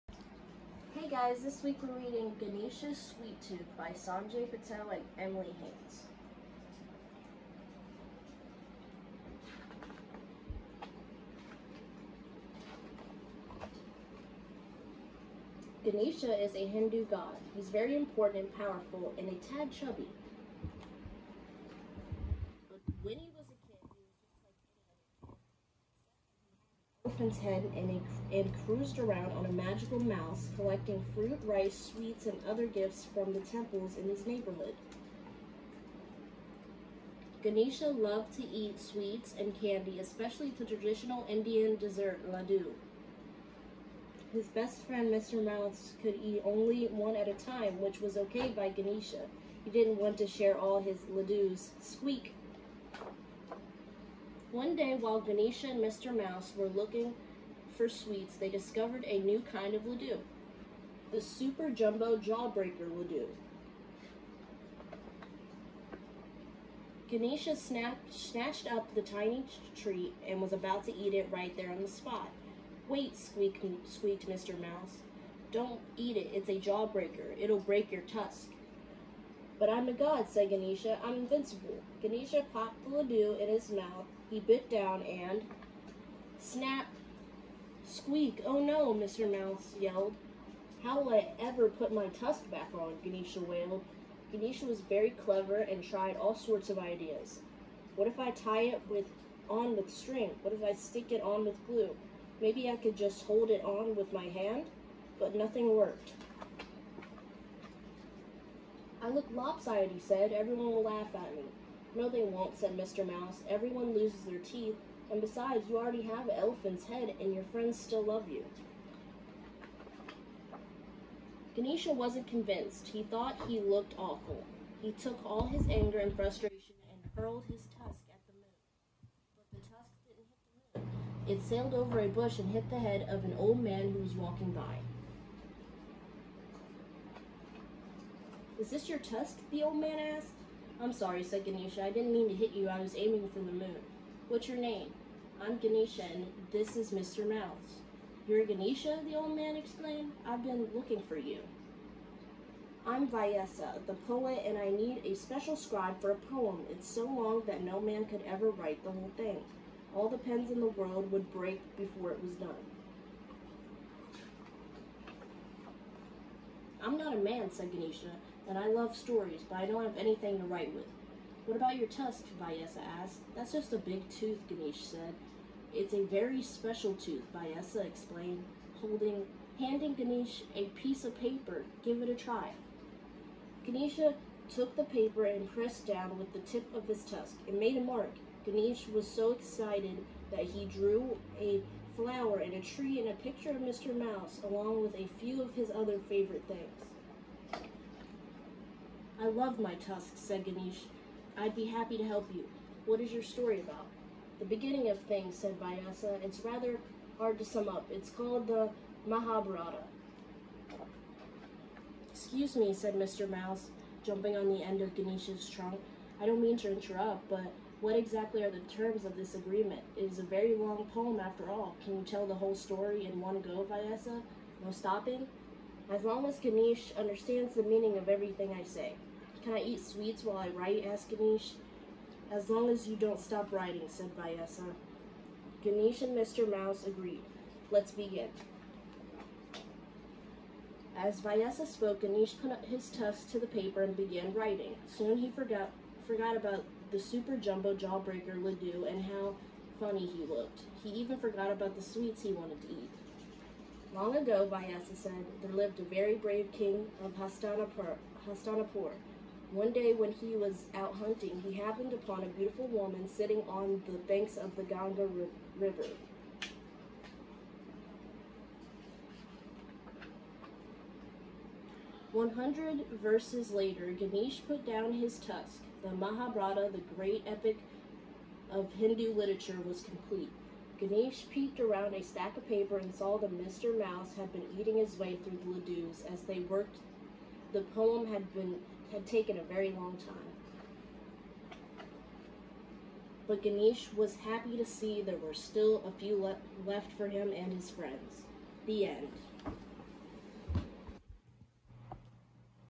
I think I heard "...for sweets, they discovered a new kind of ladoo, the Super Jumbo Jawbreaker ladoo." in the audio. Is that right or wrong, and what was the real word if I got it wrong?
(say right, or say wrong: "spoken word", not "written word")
right.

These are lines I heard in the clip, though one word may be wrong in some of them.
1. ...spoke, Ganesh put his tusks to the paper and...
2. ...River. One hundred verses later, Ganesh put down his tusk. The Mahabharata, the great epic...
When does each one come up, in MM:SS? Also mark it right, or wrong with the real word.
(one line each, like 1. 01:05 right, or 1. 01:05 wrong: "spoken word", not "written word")
1. 04:01 right
2. 04:25 right.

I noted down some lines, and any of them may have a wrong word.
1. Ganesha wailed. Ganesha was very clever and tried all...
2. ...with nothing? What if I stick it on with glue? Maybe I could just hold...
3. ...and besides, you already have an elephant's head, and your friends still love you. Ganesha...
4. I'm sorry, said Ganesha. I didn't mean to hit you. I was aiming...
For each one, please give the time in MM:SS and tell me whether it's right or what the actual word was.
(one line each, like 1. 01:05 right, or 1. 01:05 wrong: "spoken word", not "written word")
1. 01:33 right
2. 01:39 wrong: "string", not "nothing"
3. 01:55 right
4. 02:20 right.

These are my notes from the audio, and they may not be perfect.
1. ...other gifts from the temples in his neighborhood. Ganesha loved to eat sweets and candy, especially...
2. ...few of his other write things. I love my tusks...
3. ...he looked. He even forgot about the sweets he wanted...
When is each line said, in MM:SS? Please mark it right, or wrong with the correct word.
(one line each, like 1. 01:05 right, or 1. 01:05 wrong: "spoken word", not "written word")
1. 00:32 right
2. 03:15 wrong: "favorite", not "write"
3. 04:10 right.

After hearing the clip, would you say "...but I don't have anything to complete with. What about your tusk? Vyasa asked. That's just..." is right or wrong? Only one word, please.
wrong.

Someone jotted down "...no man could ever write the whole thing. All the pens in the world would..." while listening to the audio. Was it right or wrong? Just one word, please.
right.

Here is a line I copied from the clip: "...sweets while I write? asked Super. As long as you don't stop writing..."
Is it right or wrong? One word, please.
wrong.